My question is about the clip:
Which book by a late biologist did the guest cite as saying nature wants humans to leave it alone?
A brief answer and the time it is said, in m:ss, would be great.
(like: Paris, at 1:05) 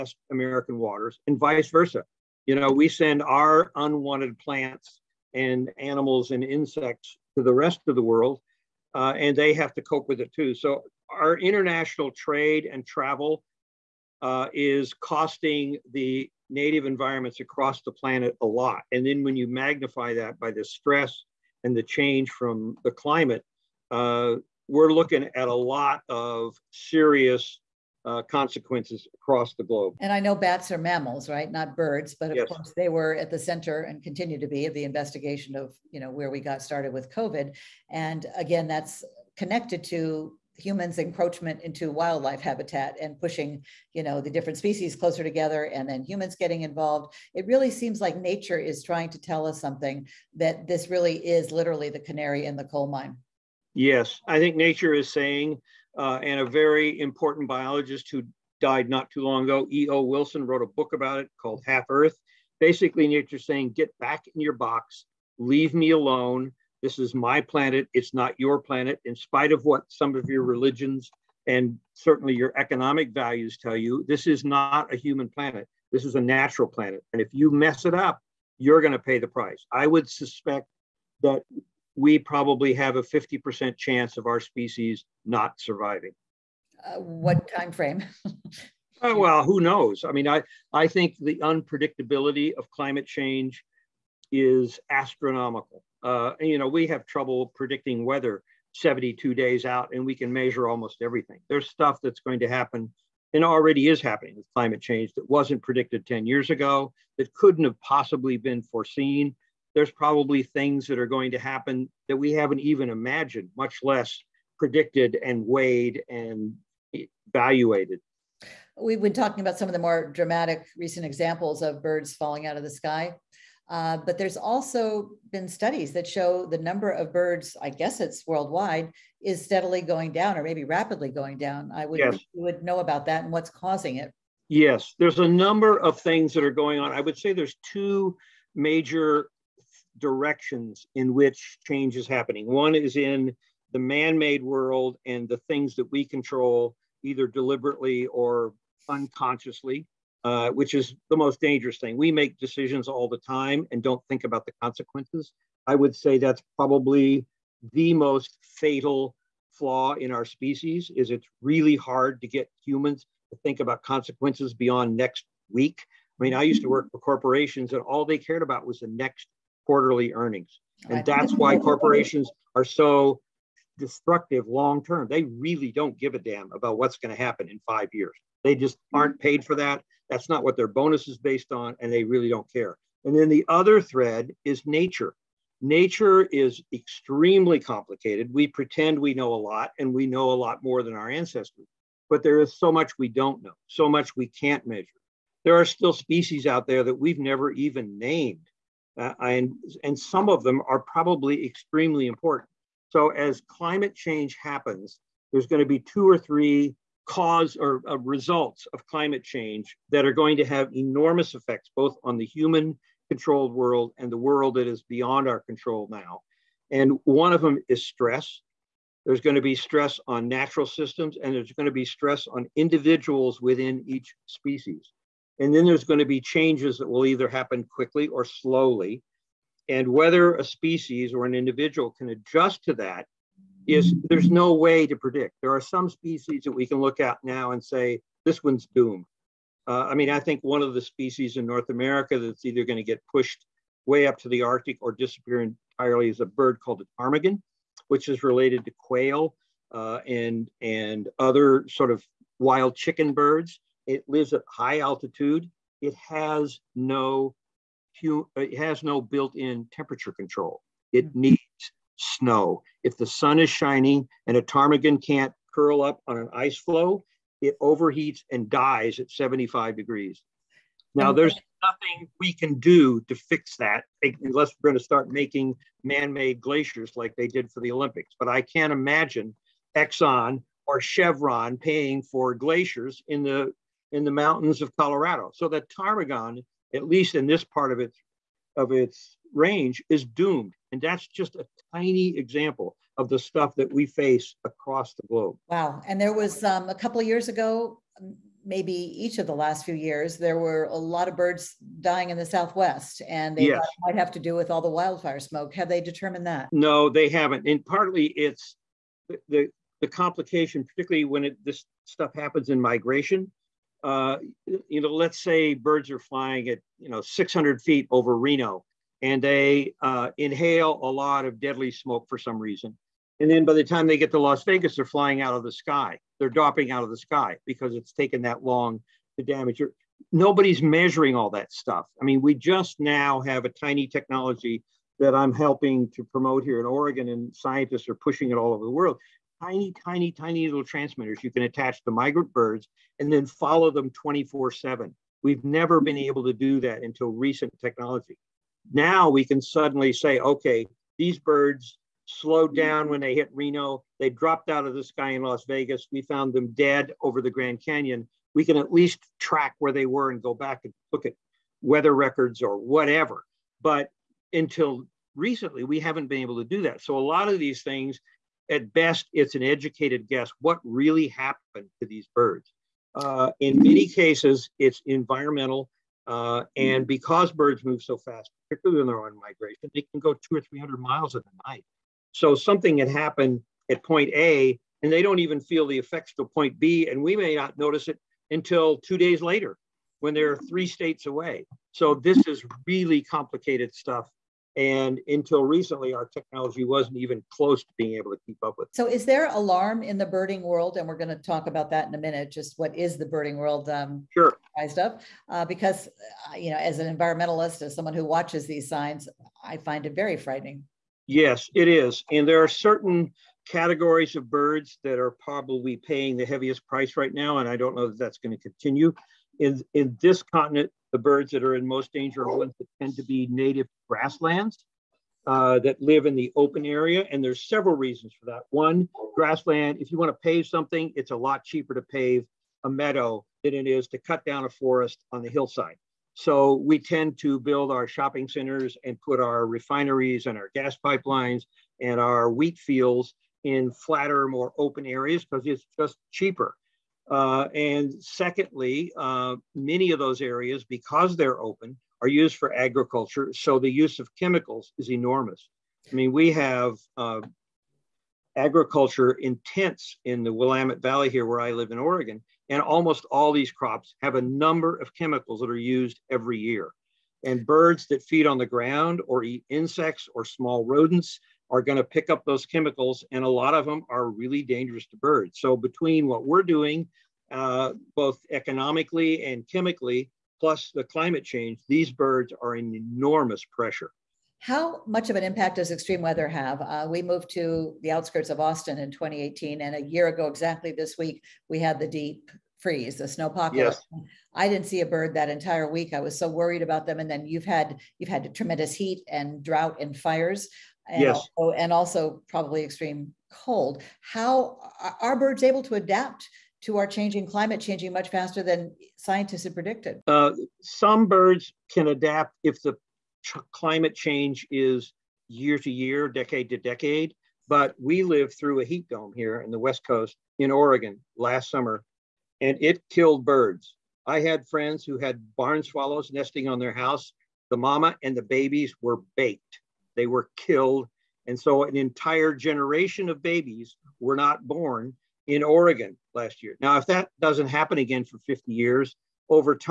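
Half Earth, at 1:01.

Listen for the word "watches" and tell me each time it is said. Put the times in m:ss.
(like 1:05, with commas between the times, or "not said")
6:48.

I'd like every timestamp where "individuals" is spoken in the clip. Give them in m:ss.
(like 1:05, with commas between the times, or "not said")
3:42, 3:51.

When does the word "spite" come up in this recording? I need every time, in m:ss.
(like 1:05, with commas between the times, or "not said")
1:09.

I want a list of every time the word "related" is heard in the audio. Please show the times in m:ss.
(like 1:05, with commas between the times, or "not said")
4:08.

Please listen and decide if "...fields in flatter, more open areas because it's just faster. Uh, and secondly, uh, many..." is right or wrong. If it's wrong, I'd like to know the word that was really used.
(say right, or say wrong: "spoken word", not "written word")
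wrong: "cheaper", not "faster".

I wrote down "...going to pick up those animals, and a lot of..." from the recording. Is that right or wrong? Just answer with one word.
wrong.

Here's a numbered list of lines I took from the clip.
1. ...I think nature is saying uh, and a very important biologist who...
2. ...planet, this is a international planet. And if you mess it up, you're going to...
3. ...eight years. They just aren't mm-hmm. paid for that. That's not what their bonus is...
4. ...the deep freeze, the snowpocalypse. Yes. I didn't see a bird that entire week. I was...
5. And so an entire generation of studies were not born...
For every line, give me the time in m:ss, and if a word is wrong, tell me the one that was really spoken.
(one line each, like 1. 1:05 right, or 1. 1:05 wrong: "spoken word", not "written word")
1. 0:54 right
2. 1:15 wrong: "natural", not "international"
3. 2:57 wrong: "five", not "eight"
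4. 8:11 right
5. 8:51 wrong: "babies", not "studies".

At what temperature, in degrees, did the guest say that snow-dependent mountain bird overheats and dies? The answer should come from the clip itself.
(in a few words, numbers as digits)
75 degrees.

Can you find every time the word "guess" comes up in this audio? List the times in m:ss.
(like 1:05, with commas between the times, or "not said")
2:07, 6:10.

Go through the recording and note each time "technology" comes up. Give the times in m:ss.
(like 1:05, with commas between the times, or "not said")
5:33, 5:47, 6:36.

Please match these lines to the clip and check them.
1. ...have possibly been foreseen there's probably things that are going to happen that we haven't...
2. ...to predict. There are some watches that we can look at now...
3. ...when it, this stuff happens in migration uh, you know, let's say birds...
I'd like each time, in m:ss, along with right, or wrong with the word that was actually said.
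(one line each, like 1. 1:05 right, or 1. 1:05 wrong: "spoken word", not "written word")
1. 1:47 right
2. 3:54 wrong: "species", not "watches"
3. 5:11 right.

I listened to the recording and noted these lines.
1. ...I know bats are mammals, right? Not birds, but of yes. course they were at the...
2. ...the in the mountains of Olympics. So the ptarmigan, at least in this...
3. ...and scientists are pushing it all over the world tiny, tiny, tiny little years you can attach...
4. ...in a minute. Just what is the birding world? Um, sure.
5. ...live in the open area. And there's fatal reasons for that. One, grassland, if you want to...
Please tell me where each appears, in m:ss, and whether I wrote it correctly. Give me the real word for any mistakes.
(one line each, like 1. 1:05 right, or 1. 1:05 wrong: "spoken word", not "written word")
1. 0:30 right
2. 4:43 wrong: "Colorado", not "Olympics"
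3. 5:37 wrong: "transmitters", not "years"
4. 6:41 right
5. 7:05 wrong: "several", not "fatal".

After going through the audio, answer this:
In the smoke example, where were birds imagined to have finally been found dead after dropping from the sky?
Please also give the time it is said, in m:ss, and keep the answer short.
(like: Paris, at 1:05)
Grand Canyon, at 5:57.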